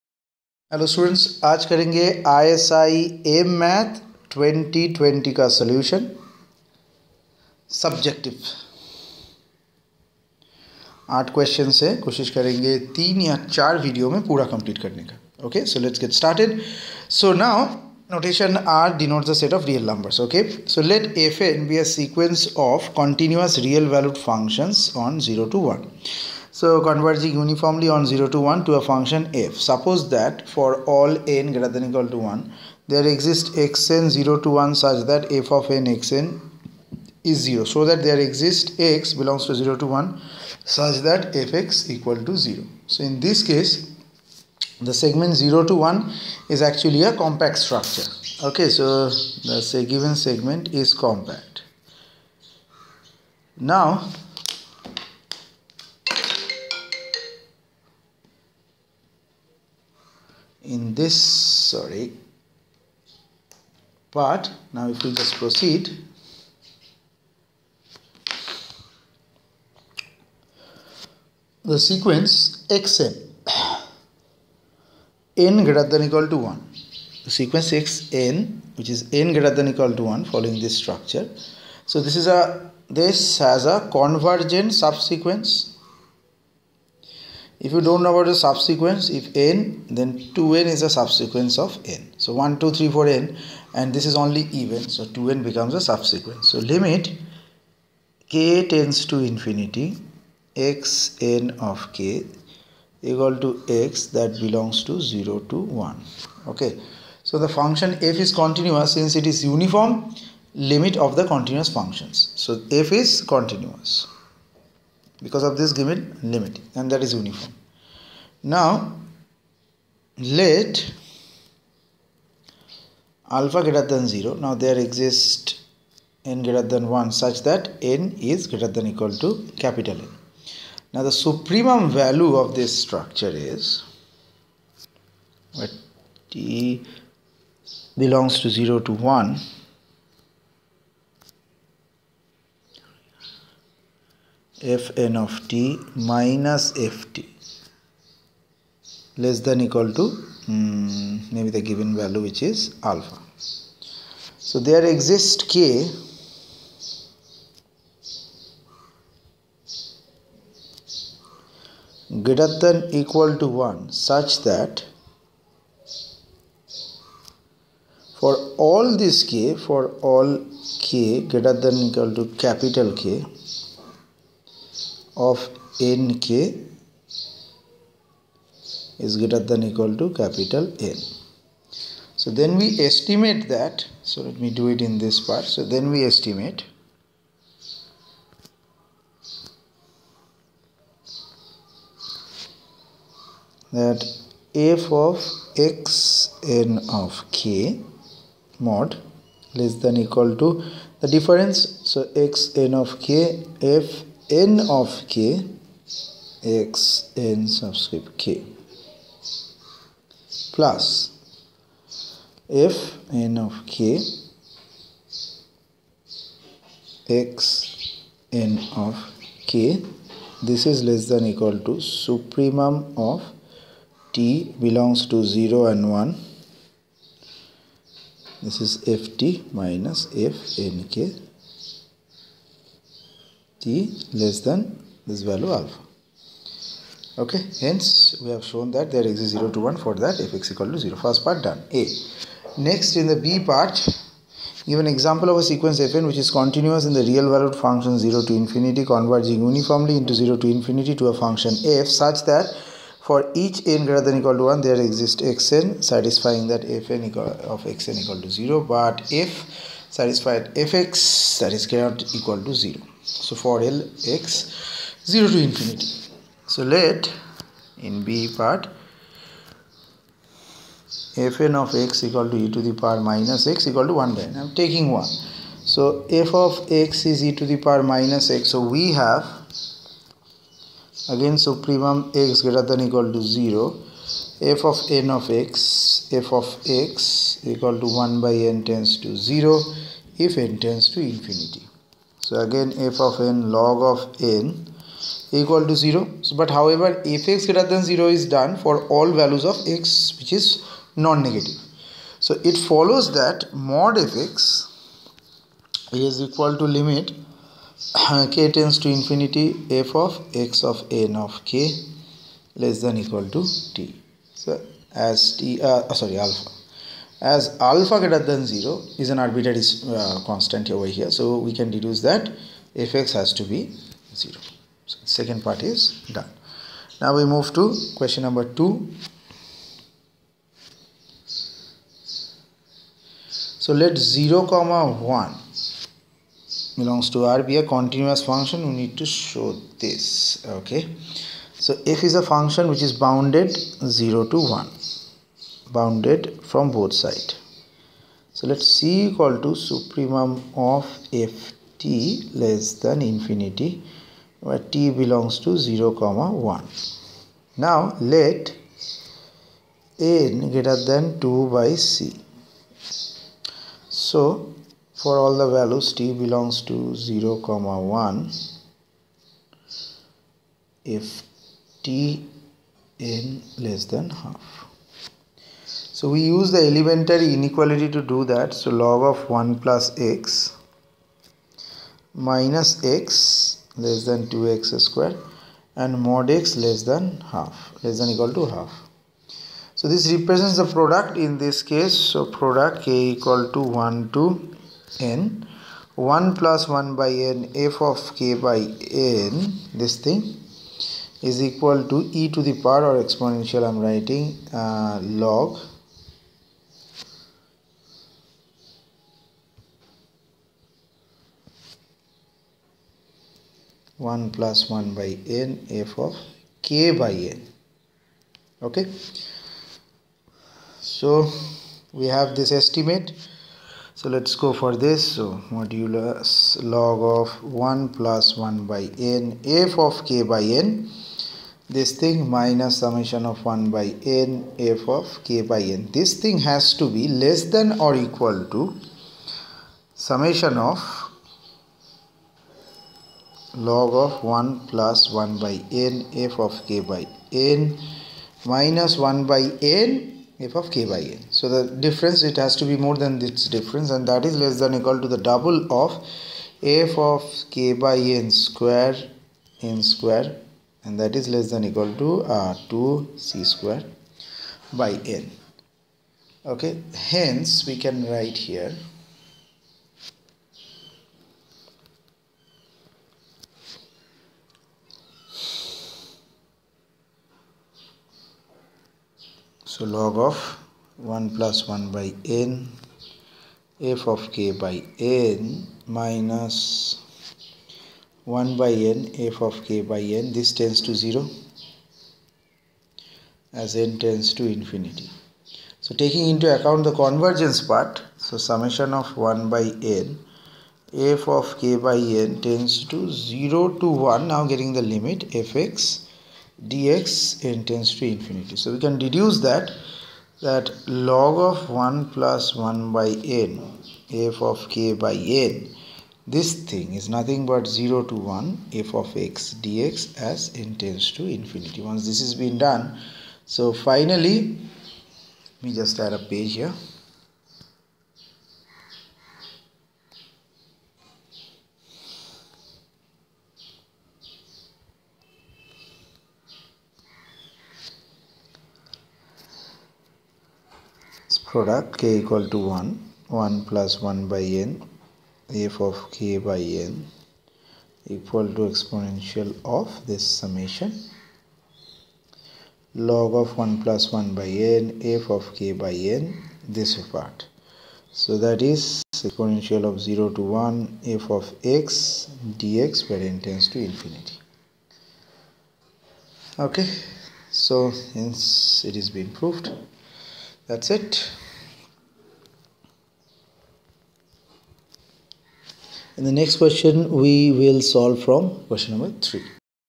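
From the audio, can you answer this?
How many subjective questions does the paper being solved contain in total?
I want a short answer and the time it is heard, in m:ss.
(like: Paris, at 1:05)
8, at 0:11.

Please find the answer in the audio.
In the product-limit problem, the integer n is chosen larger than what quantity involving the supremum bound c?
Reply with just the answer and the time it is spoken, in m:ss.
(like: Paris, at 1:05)
2/c, at 6:01.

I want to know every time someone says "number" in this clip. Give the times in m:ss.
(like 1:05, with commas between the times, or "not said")
5:28, 9:38.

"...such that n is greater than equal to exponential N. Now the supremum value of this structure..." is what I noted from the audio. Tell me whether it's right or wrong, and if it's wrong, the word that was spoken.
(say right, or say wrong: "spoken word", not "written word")
wrong: "capital", not "exponential".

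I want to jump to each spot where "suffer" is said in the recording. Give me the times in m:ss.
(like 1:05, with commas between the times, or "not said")
not said.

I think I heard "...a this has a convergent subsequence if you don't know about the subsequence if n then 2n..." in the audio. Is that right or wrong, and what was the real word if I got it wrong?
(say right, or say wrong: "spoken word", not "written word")
right.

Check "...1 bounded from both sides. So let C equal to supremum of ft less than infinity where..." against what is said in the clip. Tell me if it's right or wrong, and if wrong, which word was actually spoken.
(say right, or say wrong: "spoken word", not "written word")
right.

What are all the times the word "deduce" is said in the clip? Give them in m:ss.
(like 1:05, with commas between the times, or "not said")
5:21, 8:28.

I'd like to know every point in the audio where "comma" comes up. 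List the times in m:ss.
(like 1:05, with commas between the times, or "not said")
5:34, 5:55, 6:07.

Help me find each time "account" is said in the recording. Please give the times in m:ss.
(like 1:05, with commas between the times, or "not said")
8:16.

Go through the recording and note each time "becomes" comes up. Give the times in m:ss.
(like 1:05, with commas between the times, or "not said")
1:35.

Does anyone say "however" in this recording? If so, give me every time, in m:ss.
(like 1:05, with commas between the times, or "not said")
4:56.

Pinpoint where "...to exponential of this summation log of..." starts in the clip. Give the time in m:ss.
9:08.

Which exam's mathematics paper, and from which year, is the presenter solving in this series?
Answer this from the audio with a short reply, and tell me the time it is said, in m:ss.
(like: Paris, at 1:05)
ISI M.Math 2020, at 0:02.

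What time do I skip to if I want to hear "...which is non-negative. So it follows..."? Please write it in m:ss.
5:00.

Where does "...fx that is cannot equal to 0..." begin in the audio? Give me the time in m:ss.
4:20.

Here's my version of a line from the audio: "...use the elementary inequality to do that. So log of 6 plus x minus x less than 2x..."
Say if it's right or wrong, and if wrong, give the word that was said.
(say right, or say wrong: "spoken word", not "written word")
wrong: "1", not "6".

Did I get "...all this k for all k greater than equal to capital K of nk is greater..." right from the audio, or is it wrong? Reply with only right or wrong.
right.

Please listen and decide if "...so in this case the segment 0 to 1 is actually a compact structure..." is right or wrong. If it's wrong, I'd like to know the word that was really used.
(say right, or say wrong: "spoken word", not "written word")
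right.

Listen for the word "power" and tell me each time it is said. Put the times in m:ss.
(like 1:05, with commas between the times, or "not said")
4:32, 4:37, 6:42.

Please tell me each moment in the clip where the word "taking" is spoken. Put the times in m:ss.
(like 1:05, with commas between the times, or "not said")
4:34, 8:15.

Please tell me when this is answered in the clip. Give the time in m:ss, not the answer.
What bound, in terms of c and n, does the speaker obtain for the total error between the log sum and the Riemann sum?
7:42.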